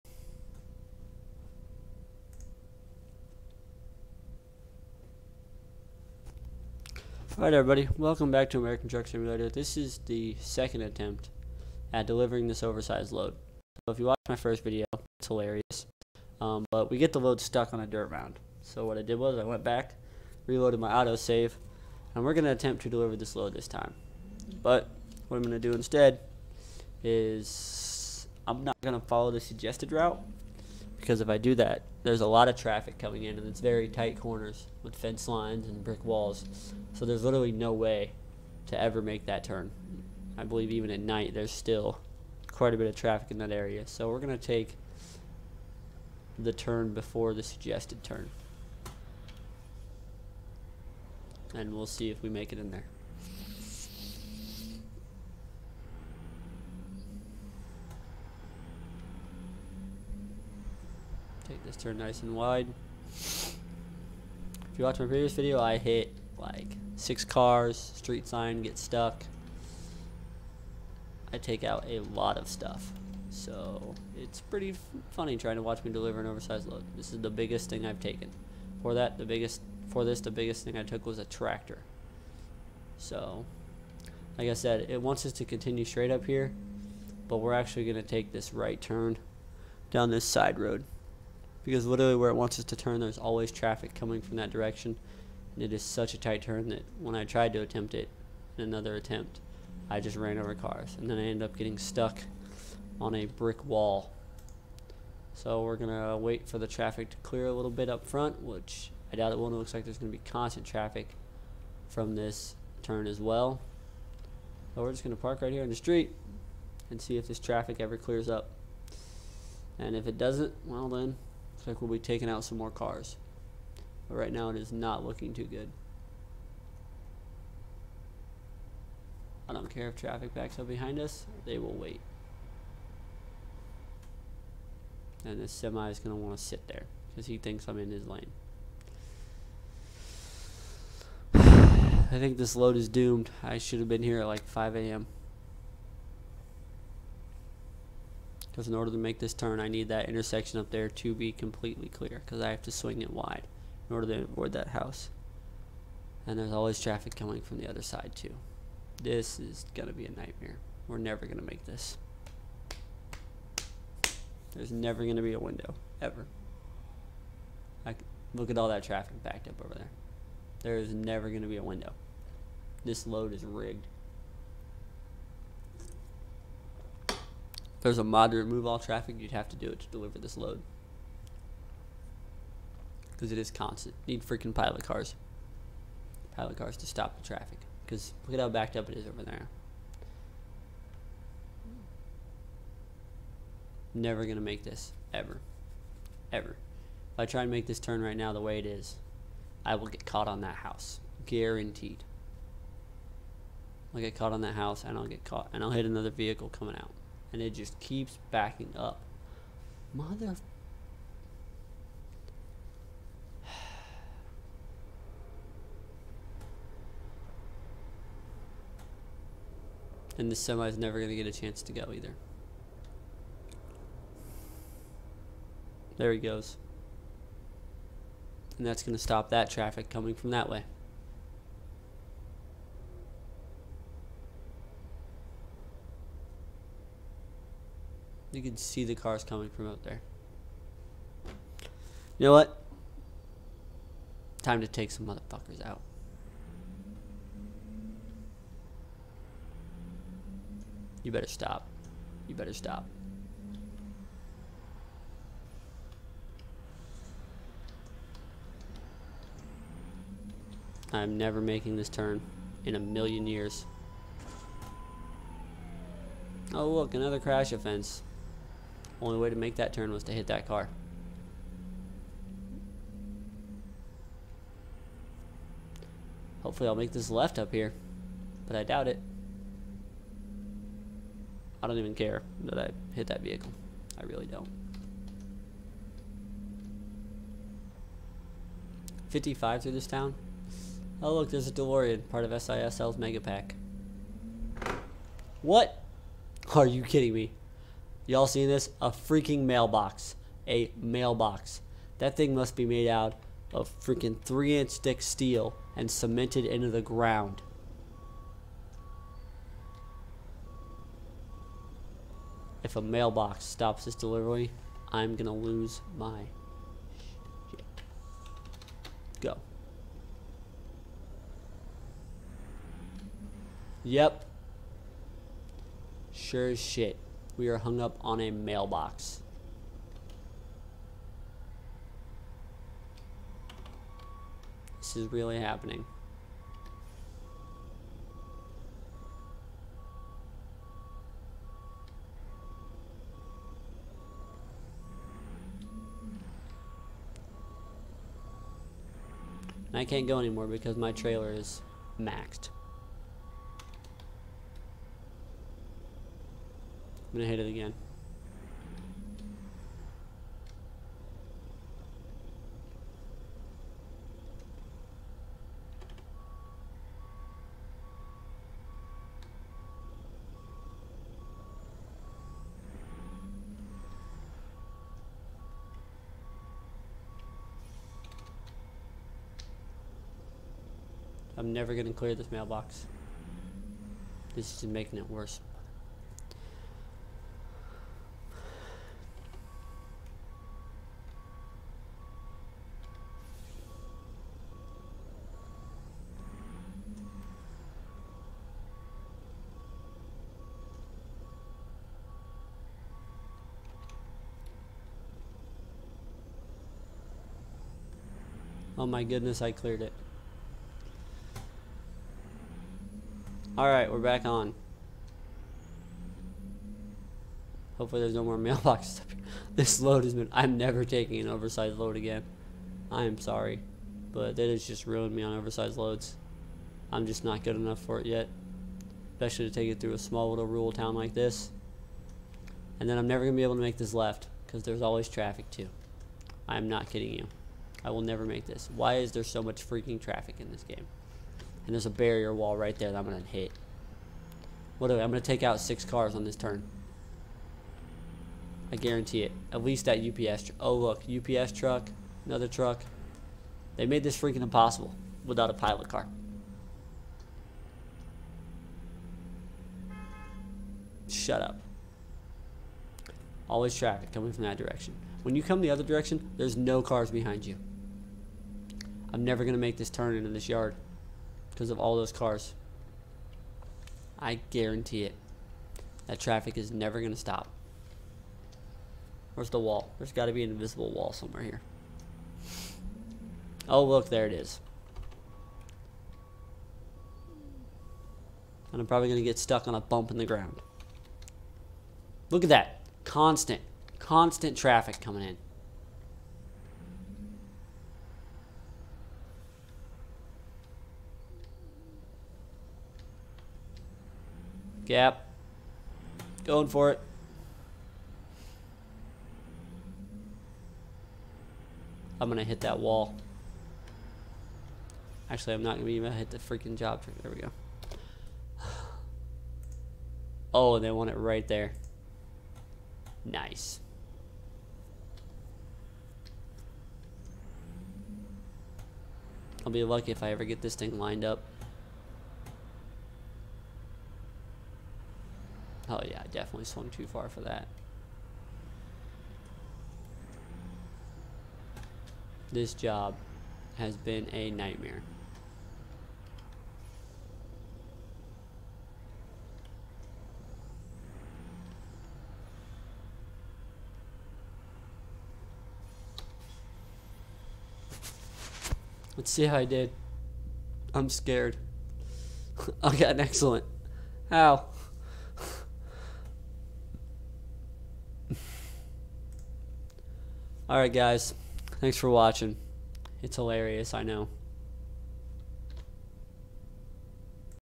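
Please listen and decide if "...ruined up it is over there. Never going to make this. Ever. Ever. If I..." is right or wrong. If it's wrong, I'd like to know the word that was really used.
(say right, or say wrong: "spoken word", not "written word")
wrong: "backed", not "ruined".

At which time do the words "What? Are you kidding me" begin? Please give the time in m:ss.
4:55.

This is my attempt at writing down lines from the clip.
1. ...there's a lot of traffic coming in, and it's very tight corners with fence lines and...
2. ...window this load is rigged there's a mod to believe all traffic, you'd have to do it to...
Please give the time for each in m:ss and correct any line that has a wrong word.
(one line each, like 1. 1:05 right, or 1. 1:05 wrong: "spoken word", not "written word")
1. 0:32 right
2. 2:51 wrong: "remove", not "believe".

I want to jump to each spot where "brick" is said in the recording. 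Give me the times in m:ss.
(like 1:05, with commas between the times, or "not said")
0:35, 1:43.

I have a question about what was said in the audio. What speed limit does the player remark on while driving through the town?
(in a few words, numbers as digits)
55.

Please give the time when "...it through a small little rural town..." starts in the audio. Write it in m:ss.
7:09.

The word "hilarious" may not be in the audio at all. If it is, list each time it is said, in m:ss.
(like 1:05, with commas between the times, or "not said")
0:15, 9:33.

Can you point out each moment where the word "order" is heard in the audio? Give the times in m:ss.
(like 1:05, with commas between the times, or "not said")
2:28, 2:33.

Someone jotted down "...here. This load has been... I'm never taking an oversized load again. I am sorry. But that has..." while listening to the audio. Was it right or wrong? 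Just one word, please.
right.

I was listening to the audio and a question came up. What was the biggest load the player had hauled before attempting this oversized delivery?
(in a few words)
A tractor.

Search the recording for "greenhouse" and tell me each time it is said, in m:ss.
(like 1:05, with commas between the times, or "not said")
not said.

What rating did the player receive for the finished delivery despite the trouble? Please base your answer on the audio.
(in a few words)
Excellent.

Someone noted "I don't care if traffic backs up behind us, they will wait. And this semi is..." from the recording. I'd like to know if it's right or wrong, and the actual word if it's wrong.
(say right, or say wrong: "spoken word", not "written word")
right.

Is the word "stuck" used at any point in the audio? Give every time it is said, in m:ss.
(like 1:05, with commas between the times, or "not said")
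0:17, 1:08, 1:41, 8:09.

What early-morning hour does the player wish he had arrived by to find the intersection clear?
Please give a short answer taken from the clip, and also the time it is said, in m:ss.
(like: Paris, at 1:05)
5 a.m., at 2:24.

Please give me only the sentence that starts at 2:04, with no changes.
But right now it is not looking too good.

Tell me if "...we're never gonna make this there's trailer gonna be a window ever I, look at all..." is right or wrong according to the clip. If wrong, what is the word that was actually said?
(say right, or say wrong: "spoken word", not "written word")
wrong: "never", not "trailer".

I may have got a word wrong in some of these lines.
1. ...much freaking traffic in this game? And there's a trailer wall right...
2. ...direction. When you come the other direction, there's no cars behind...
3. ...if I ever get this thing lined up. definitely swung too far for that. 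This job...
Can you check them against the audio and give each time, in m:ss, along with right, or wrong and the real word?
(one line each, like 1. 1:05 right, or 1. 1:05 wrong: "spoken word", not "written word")
1. 7:19 wrong: "barrier", not "trailer"
2. 7:44 right
3. 8:50 right.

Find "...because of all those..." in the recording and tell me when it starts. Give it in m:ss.
7:51.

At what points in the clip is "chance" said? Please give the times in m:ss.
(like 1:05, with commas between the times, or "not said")
3:41.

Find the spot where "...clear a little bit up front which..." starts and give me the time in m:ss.
1:47.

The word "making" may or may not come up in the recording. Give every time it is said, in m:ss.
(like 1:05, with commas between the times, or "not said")
4:21, 6:24.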